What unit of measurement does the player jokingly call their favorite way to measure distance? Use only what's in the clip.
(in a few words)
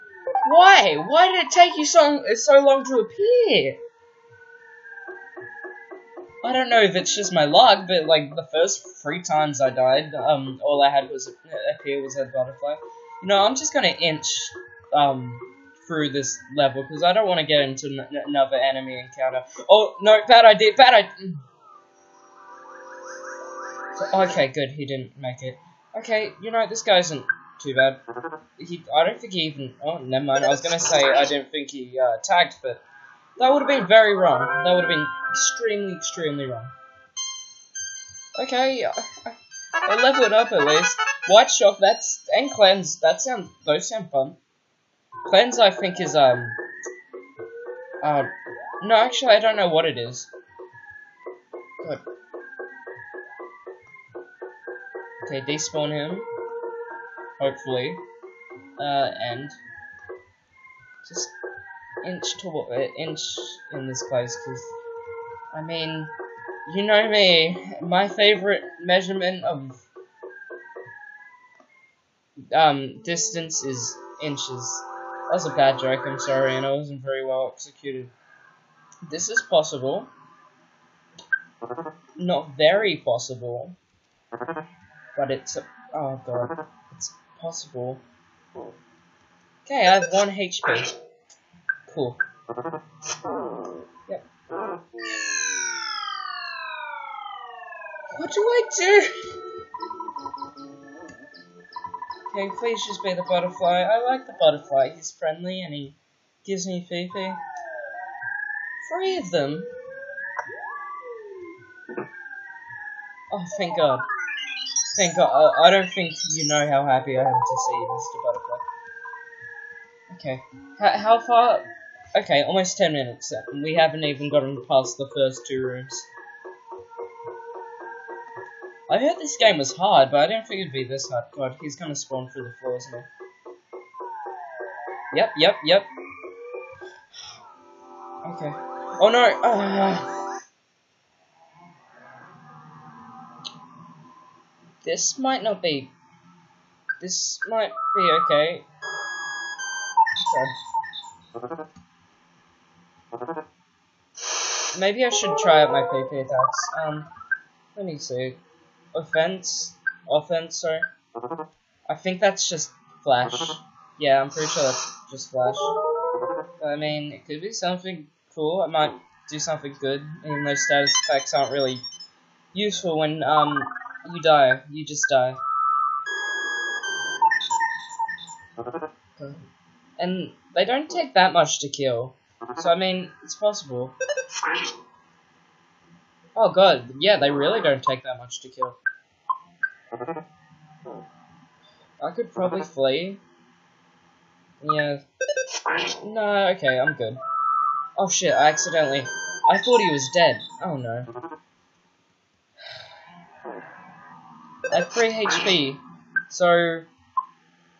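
Inches.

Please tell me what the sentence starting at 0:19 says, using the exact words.
Oh no, bad idea, bad idea.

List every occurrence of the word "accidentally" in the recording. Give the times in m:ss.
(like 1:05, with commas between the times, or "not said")
3:18.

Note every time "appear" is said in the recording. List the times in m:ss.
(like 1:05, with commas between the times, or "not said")
0:02, 0:11.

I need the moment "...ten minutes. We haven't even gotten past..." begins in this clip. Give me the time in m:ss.
2:02.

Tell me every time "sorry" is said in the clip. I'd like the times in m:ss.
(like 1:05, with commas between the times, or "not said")
1:16, 2:40.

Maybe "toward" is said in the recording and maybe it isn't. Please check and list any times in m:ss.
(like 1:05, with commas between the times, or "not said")
1:02.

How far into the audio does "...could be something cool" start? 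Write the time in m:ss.
2:47.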